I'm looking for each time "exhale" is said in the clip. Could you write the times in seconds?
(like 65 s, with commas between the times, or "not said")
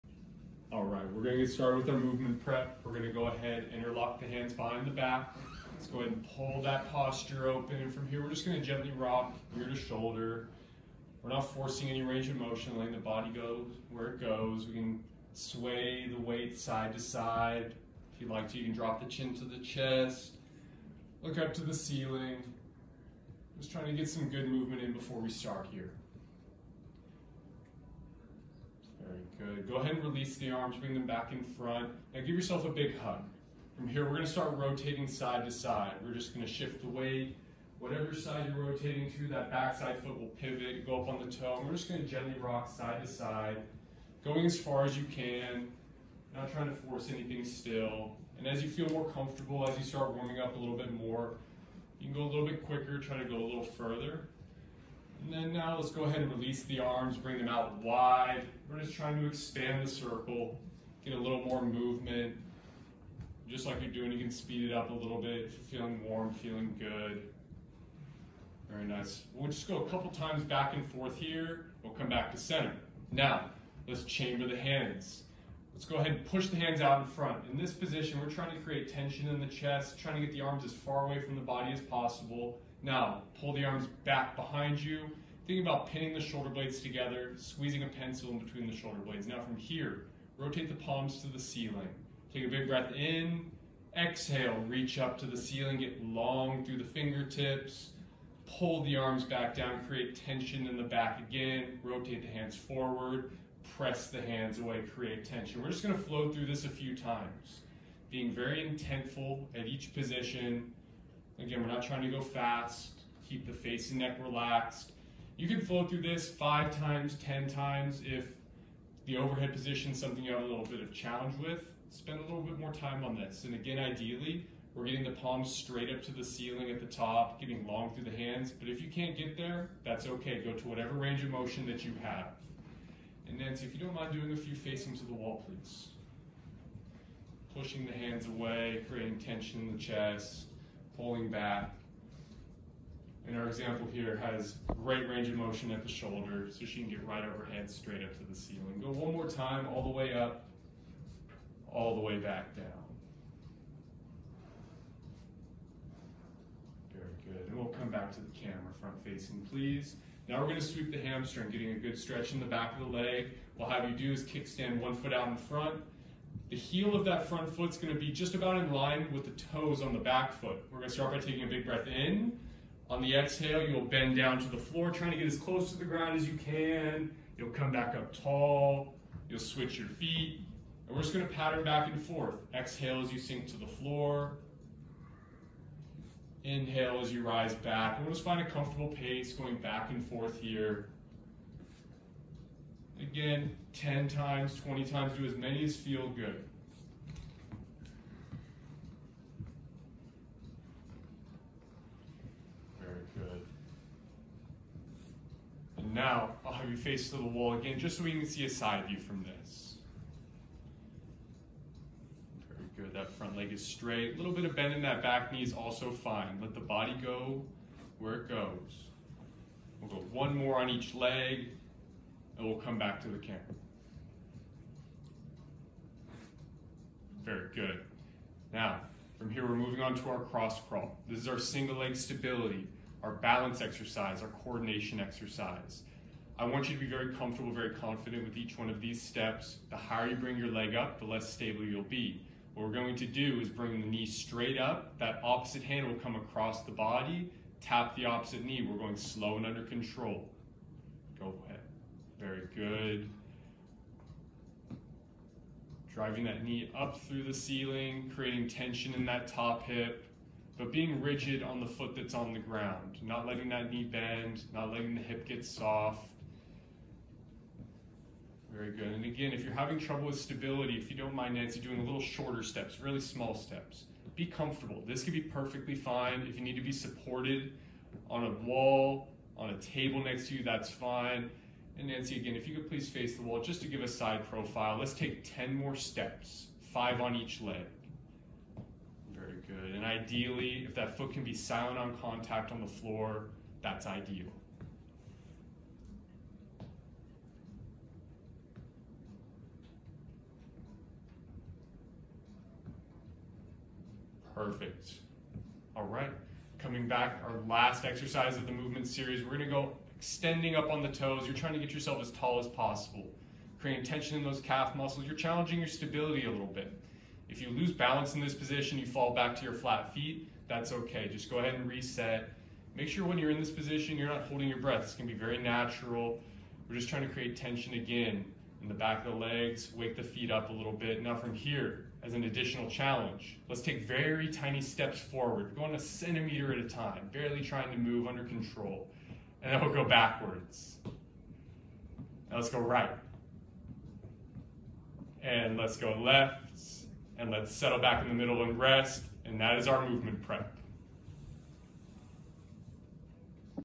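93 s, 173 s, 182 s.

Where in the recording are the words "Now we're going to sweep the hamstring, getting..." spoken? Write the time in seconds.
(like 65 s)
160 s.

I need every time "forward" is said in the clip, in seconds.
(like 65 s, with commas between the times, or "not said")
102 s, 334 s.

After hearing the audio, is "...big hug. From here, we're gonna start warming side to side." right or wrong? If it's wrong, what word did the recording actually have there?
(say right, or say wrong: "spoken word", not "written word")
wrong: "rotating", not "warming".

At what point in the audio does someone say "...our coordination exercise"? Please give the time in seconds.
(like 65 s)
234 s.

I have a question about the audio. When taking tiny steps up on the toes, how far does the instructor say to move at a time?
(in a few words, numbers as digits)
a centimeter.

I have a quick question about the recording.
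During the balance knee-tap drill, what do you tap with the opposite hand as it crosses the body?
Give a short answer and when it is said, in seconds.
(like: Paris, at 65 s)
the opposite knee, at 248 s.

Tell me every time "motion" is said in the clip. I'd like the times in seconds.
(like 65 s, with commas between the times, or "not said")
12 s, 131 s, 145 s.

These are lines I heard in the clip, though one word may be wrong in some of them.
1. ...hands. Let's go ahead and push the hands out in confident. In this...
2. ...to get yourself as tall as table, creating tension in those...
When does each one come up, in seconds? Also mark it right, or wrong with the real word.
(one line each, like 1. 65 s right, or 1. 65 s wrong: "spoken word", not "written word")
1. 74 s wrong: "front", not "confident"
2. 311 s wrong: "possible", not "table".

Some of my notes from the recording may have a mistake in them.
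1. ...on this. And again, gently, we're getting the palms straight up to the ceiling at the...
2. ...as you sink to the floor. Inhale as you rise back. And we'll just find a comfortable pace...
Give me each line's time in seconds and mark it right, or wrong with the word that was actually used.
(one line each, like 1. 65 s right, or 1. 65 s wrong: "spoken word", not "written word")
1. 123 s wrong: "ideally", not "gently"
2. 183 s right.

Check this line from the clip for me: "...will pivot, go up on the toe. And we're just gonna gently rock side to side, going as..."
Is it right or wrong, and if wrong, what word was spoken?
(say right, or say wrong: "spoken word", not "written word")
right.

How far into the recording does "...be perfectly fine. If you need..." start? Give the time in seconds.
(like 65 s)
275 s.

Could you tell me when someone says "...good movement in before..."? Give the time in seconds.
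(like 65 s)
24 s.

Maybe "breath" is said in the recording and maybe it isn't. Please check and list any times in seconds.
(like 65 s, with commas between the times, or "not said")
92 s, 171 s, 324 s.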